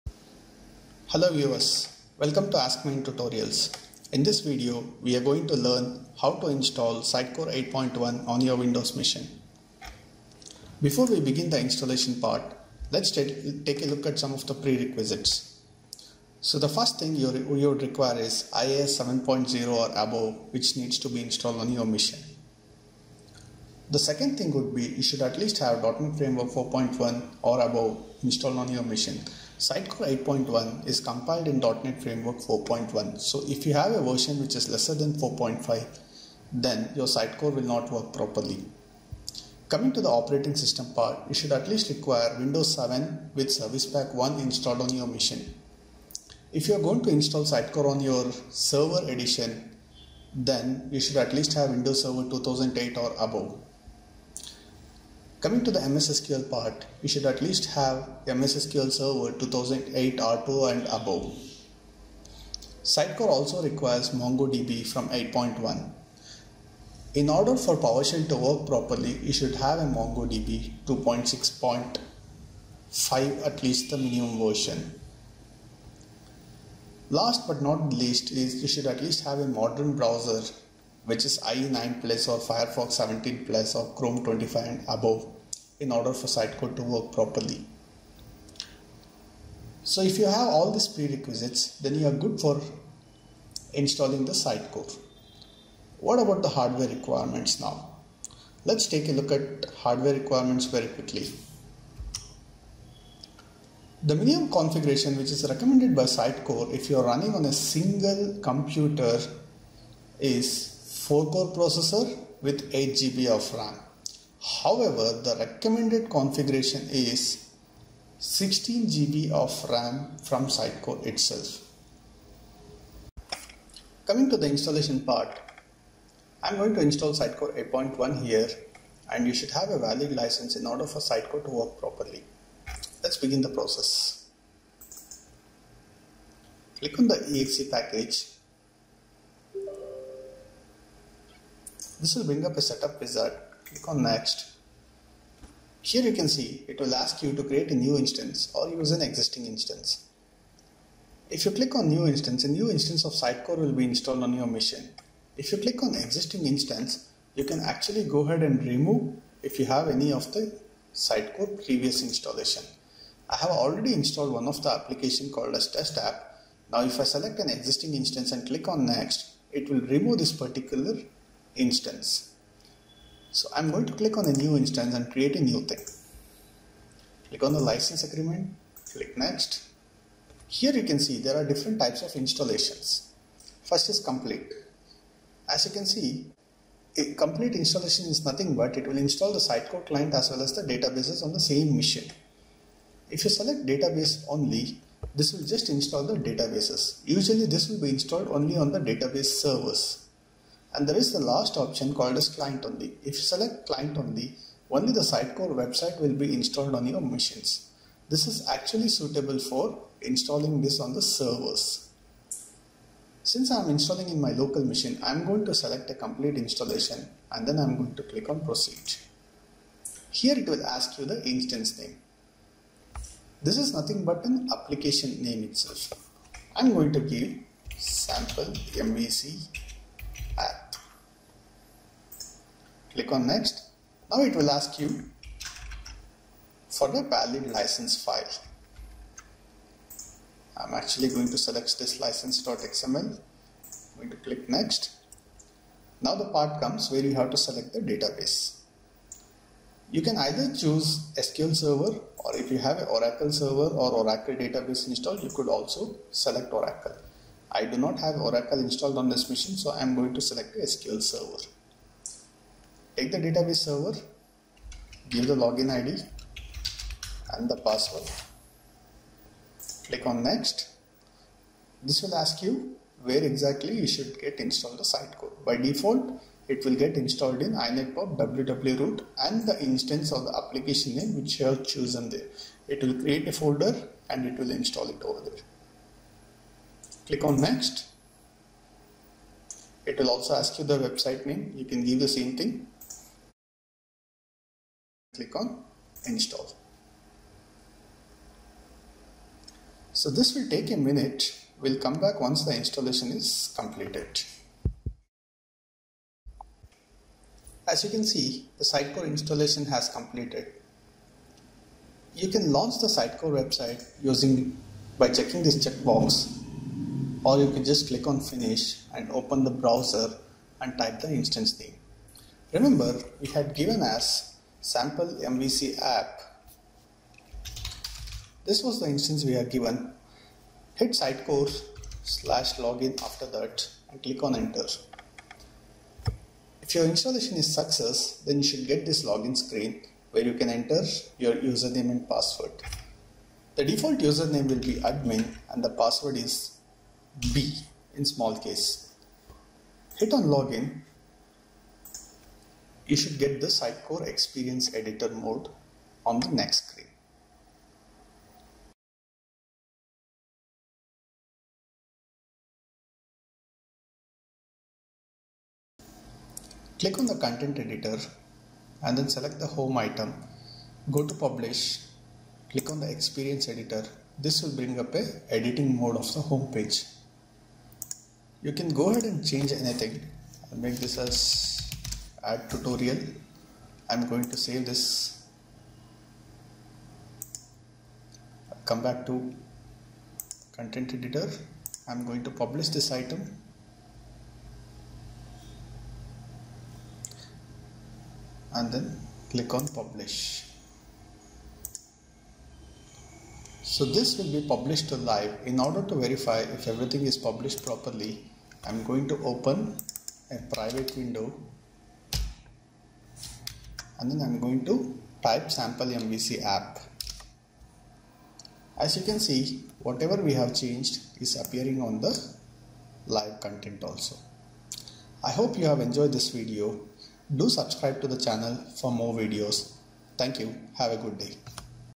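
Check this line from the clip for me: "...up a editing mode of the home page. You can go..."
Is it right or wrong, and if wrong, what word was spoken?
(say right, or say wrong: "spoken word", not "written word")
right.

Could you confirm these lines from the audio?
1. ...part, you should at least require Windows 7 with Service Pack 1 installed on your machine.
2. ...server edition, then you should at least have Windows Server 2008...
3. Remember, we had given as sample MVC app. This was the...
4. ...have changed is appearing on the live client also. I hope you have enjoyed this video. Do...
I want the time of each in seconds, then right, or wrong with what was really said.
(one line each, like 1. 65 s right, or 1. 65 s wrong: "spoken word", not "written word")
1. 40 s right
2. 48 s right
3. 322 s right
4. 420 s wrong: "content", not "client".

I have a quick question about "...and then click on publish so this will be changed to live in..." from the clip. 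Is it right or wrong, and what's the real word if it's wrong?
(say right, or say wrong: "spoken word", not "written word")
wrong: "published", not "changed".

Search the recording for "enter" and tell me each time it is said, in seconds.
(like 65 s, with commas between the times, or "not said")
334 s, 340 s.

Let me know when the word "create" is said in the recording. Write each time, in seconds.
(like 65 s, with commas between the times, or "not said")
147 s, 175 s, 282 s.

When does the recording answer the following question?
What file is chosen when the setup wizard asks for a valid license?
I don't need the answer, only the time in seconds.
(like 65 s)
242 s.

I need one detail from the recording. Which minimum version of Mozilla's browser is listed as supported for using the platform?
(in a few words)
Firefox 17.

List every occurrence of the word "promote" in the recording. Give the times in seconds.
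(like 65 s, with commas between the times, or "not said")
not said.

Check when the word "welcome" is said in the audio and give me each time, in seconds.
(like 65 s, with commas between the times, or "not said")
2 s.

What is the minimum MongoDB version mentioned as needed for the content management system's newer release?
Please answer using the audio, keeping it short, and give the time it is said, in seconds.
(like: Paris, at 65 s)
2.6.5, at 70 s.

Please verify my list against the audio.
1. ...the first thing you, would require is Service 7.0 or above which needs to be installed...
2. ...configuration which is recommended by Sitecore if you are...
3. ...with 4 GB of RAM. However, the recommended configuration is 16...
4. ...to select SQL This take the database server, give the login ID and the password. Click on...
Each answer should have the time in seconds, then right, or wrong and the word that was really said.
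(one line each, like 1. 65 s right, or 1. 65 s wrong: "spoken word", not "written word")
1. 16 s wrong: "IIS", not "Service"
2. 104 s right
3. 112 s wrong: "8", not "4"
4. 260 s wrong: "Server", not "This".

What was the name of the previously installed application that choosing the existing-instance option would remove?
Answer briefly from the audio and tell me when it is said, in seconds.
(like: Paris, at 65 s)
test app, at 165 s.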